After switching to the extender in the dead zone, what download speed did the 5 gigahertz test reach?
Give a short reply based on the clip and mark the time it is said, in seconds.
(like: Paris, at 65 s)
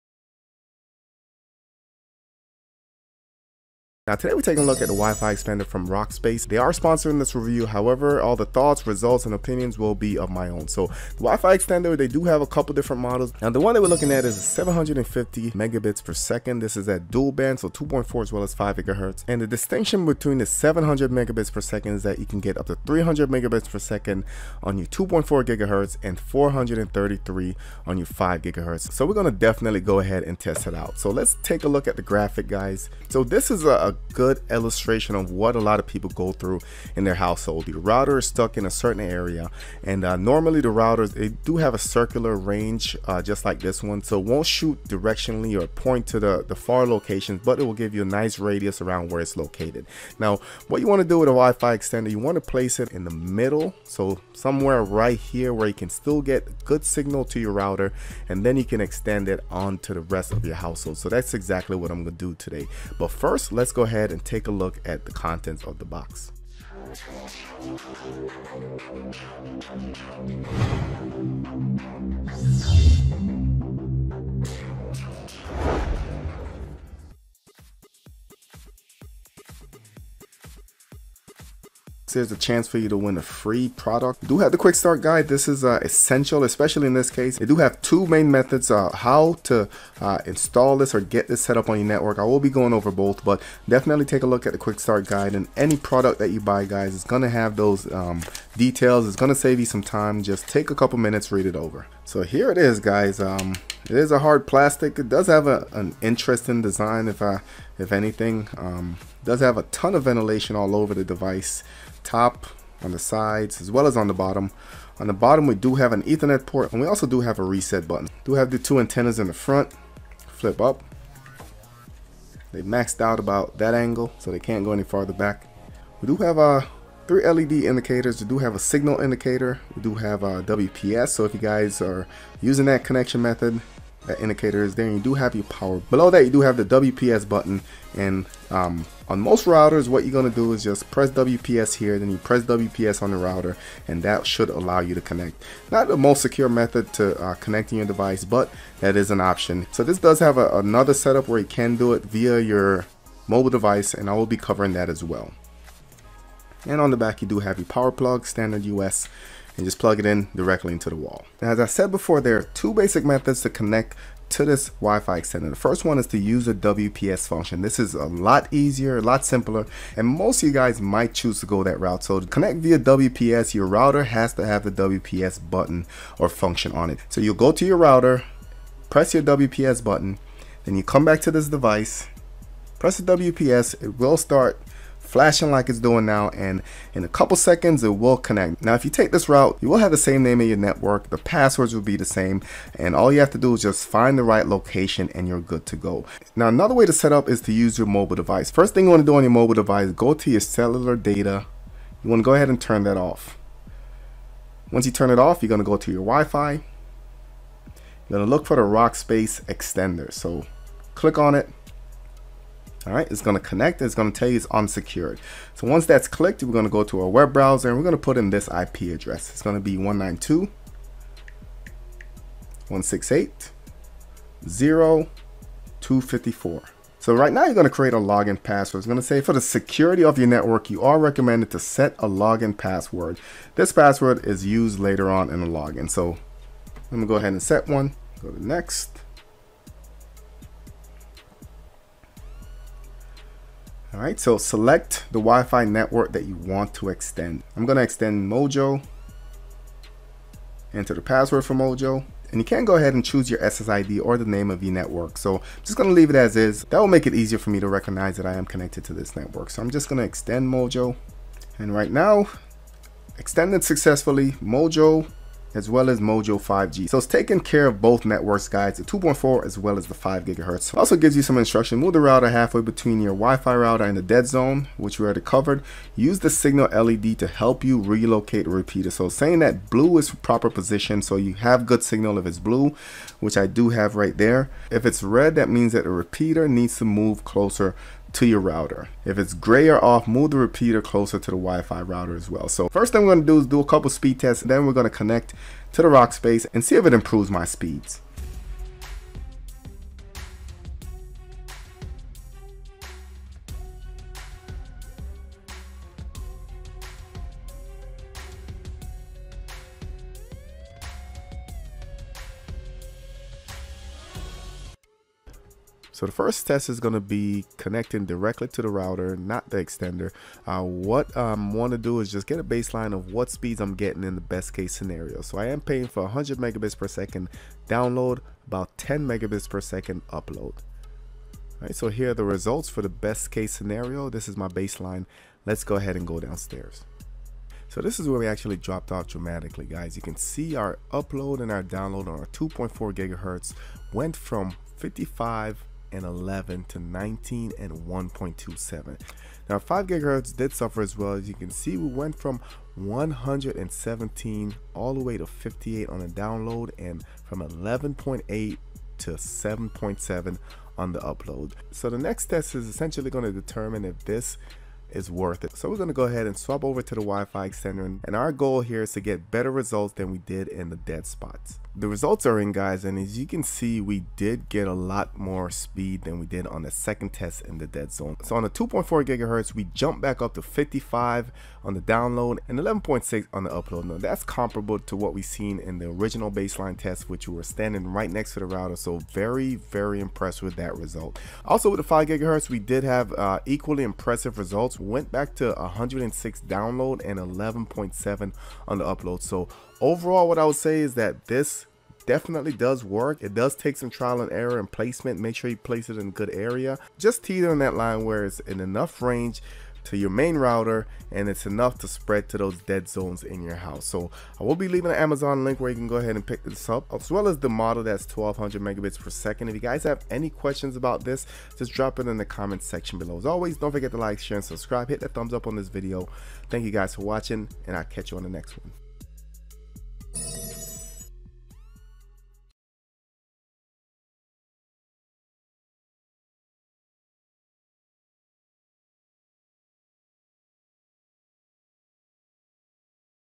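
106, at 395 s.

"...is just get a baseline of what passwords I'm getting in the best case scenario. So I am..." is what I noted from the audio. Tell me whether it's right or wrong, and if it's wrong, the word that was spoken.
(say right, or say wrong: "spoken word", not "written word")
wrong: "speeds", not "passwords".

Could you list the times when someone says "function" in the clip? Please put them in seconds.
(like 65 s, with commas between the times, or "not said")
167 s, 176 s.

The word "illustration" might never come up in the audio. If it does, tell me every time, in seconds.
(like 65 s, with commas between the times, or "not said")
34 s.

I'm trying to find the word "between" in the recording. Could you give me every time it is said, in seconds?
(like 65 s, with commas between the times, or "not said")
20 s, 272 s.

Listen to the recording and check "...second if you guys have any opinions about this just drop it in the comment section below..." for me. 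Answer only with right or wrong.
wrong.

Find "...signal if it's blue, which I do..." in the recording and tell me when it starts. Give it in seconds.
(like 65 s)
281 s.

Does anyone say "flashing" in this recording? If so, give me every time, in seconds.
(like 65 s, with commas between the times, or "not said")
185 s.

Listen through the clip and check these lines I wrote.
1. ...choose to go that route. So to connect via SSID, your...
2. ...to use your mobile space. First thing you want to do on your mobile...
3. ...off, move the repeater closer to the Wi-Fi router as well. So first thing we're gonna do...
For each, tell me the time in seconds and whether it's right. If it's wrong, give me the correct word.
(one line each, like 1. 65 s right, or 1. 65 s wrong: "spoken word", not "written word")
1. 171 s wrong: "WPS", not "SSID"
2. 197 s wrong: "device", not "space"
3. 289 s right.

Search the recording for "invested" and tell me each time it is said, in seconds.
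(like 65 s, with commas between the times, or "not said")
not said.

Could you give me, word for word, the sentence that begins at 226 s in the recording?
So right now you're going to create a login password.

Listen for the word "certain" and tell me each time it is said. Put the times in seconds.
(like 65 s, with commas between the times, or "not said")
38 s.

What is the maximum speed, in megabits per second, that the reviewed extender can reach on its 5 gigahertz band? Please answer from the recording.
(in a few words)
433.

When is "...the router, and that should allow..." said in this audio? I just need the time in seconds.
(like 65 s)
143 s.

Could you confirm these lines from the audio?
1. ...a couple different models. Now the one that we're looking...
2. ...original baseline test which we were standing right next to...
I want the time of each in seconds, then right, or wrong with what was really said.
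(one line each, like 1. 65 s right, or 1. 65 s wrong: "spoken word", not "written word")
1. 12 s right
2. 385 s right.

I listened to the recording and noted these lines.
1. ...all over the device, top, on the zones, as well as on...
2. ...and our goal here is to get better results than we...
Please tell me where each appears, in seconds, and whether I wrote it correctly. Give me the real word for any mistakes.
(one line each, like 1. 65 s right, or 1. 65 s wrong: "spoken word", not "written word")
1. 110 s wrong: "sides", not "zones"
2. 368 s right.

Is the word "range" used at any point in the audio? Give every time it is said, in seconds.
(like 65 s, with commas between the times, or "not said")
42 s, 409 s.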